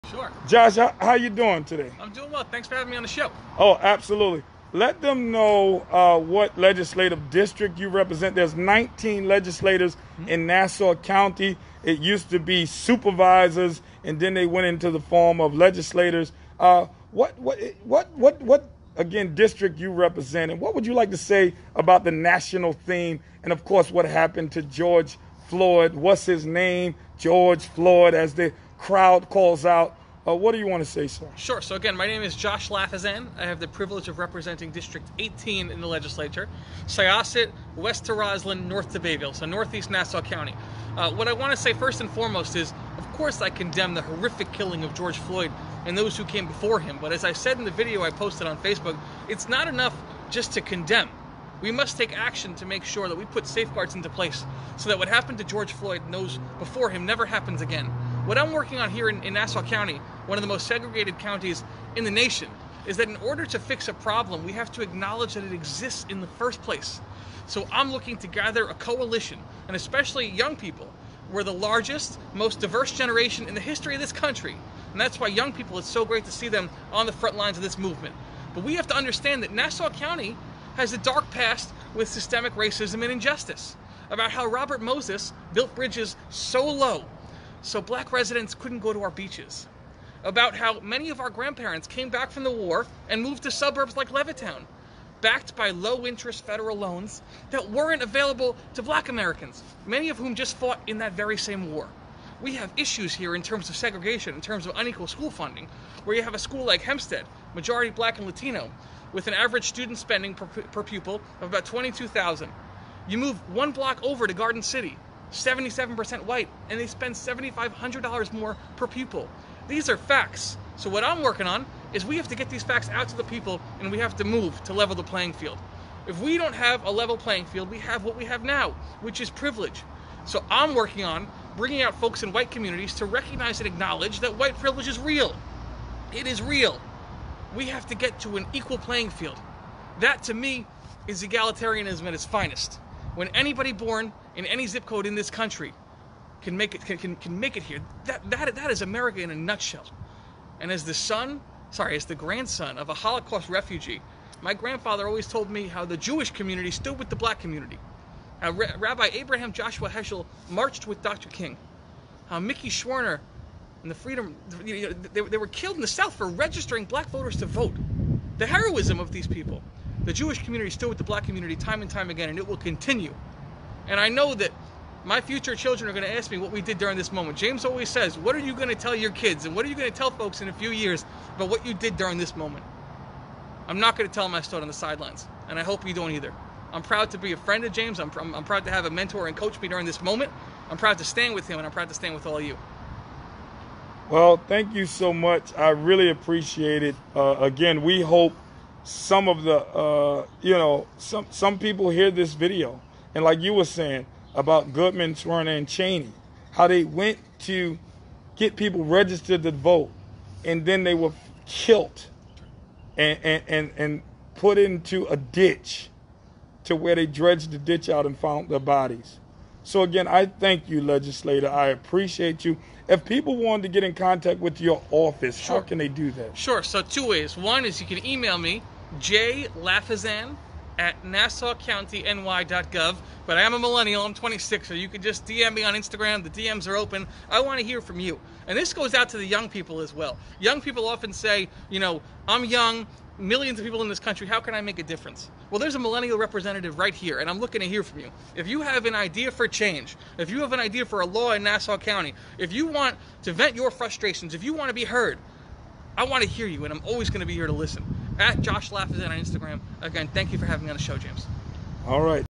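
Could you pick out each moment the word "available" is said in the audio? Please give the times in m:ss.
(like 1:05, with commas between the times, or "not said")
1:38.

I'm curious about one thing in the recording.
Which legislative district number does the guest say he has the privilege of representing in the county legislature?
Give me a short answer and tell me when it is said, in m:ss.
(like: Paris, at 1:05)
18, at 0:34.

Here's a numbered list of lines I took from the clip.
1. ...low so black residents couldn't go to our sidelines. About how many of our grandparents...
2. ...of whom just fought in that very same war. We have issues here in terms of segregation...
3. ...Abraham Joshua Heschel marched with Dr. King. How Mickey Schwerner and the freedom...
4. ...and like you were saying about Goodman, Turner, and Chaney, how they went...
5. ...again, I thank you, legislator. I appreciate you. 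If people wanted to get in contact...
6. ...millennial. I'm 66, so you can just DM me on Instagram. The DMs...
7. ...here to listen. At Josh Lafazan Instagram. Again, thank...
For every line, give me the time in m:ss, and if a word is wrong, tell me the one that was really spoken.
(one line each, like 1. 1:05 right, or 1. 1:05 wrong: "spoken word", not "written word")
1. 1:26 wrong: "beaches", not "sidelines"
2. 1:40 right
3. 2:39 right
4. 3:23 right
5. 3:39 right
6. 3:53 wrong: "26", not "66"
7. 4:17 right.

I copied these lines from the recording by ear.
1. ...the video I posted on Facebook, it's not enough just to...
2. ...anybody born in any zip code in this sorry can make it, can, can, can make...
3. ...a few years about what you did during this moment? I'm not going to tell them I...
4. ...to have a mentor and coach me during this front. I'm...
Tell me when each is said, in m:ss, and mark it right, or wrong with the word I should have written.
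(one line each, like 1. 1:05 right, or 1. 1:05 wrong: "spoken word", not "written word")
1. 0:47 right
2. 2:23 wrong: "country", not "sorry"
3. 3:00 right
4. 3:08 wrong: "moment", not "front".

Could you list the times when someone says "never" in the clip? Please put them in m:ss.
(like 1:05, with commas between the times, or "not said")
0:57.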